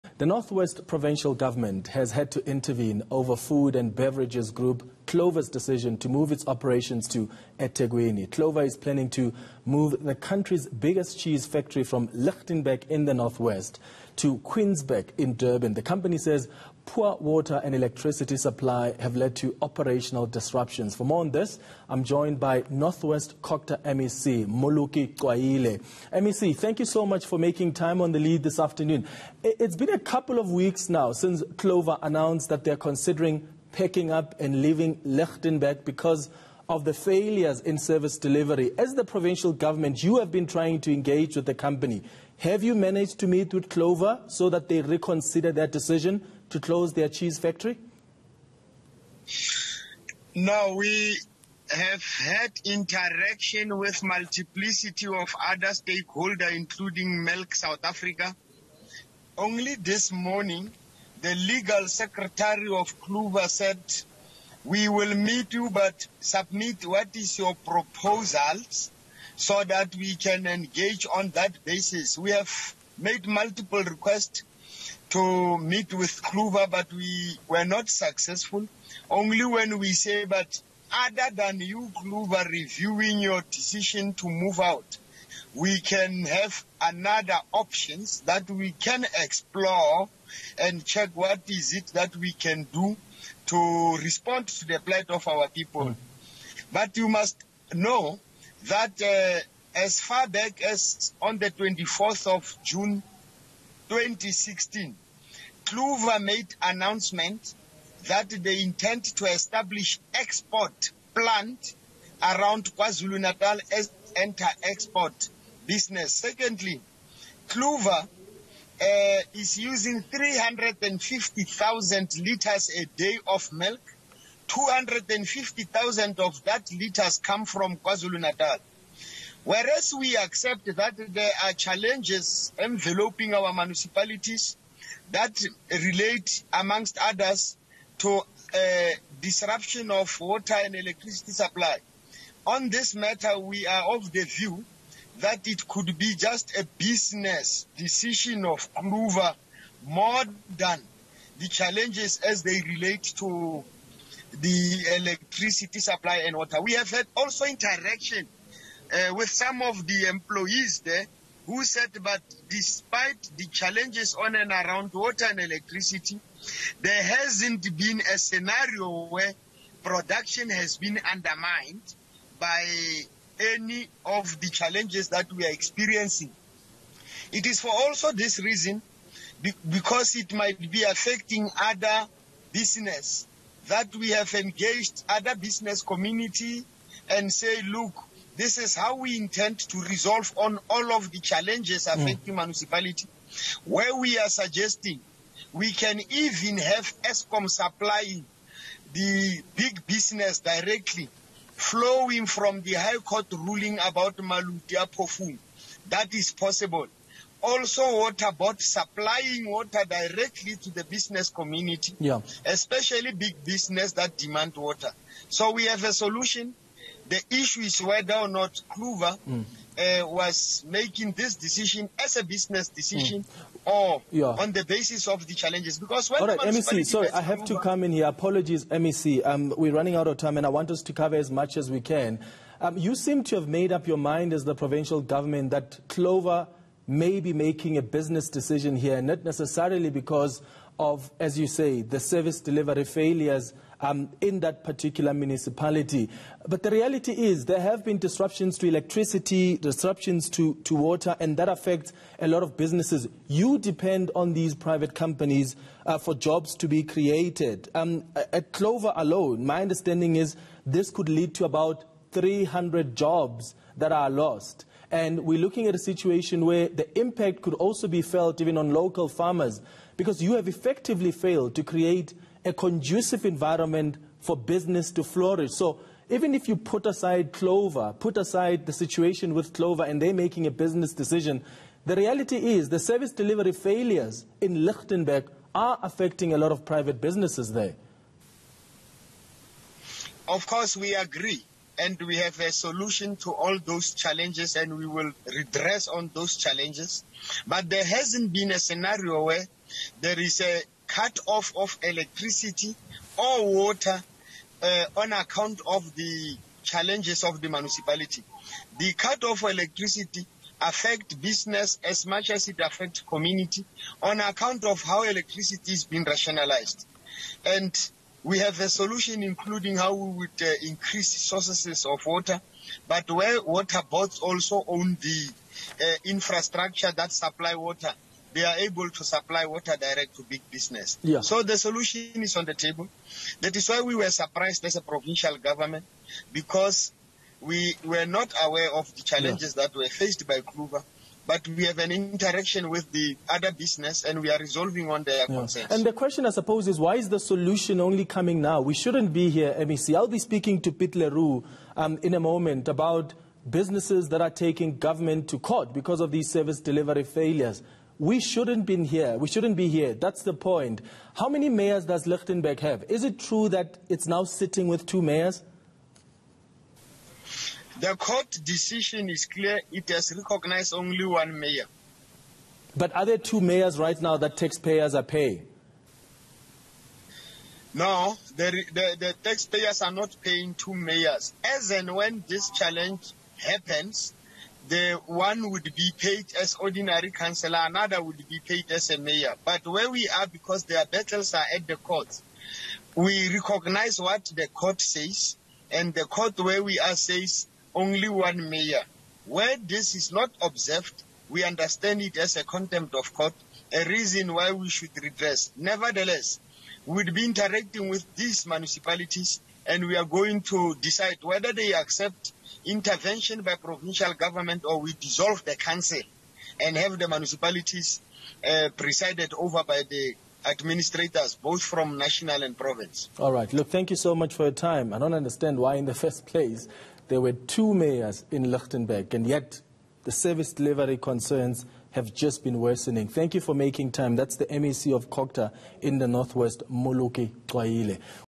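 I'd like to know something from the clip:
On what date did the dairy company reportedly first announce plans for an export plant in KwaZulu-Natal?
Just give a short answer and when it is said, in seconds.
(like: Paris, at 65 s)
24 June 2016, at 101 s.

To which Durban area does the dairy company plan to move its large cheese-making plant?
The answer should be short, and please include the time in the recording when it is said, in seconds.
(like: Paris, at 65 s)
Queensburgh, at 14 s.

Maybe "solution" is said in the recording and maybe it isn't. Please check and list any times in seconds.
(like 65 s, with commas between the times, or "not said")
215 s, 292 s, 318 s, 331 s, 347 s.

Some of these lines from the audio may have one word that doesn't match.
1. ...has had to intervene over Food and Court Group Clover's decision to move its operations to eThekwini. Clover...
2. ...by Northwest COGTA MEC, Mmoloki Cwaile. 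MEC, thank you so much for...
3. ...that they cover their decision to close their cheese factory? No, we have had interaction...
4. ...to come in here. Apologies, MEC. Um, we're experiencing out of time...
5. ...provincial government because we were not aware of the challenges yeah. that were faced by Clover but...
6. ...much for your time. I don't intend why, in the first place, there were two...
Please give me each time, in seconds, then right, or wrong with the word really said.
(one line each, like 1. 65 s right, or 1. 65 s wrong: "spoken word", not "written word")
1. 1 s wrong: "Beverages", not "Court"
2. 22 s right
3. 44 s wrong: "reconsider", not "cover"
4. 227 s wrong: "running", not "experiencing"
5. 334 s right
6. 424 s wrong: "understand", not "intend".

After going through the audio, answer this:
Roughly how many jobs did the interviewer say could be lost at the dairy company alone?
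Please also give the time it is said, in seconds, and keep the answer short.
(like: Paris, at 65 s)
300, at 262 s.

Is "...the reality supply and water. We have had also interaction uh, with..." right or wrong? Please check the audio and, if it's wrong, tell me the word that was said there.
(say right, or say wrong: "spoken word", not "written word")
wrong: "electricity", not "reality".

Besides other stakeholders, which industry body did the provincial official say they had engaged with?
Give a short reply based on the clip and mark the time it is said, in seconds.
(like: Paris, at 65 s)
Milk South Africa, at 57 s.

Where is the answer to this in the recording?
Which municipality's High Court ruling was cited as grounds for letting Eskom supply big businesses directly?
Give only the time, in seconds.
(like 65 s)
204 s.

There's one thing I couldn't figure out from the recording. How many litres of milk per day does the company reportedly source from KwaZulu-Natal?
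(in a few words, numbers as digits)
250,000.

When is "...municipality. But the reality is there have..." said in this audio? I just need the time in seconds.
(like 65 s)
245 s.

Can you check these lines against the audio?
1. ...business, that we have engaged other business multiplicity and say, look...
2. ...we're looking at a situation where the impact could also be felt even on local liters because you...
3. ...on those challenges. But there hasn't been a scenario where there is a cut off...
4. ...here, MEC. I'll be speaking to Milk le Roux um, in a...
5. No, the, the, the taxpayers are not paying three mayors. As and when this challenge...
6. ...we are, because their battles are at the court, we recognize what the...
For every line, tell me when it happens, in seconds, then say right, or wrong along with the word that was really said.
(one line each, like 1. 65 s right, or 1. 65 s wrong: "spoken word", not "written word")
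1. 182 s wrong: "community", not "multiplicity"
2. 265 s wrong: "farmers", not "liters"
3. 295 s right
4. 349 s wrong: "Piet", not "Milk"
5. 377 s wrong: "two", not "three"
6. 389 s right.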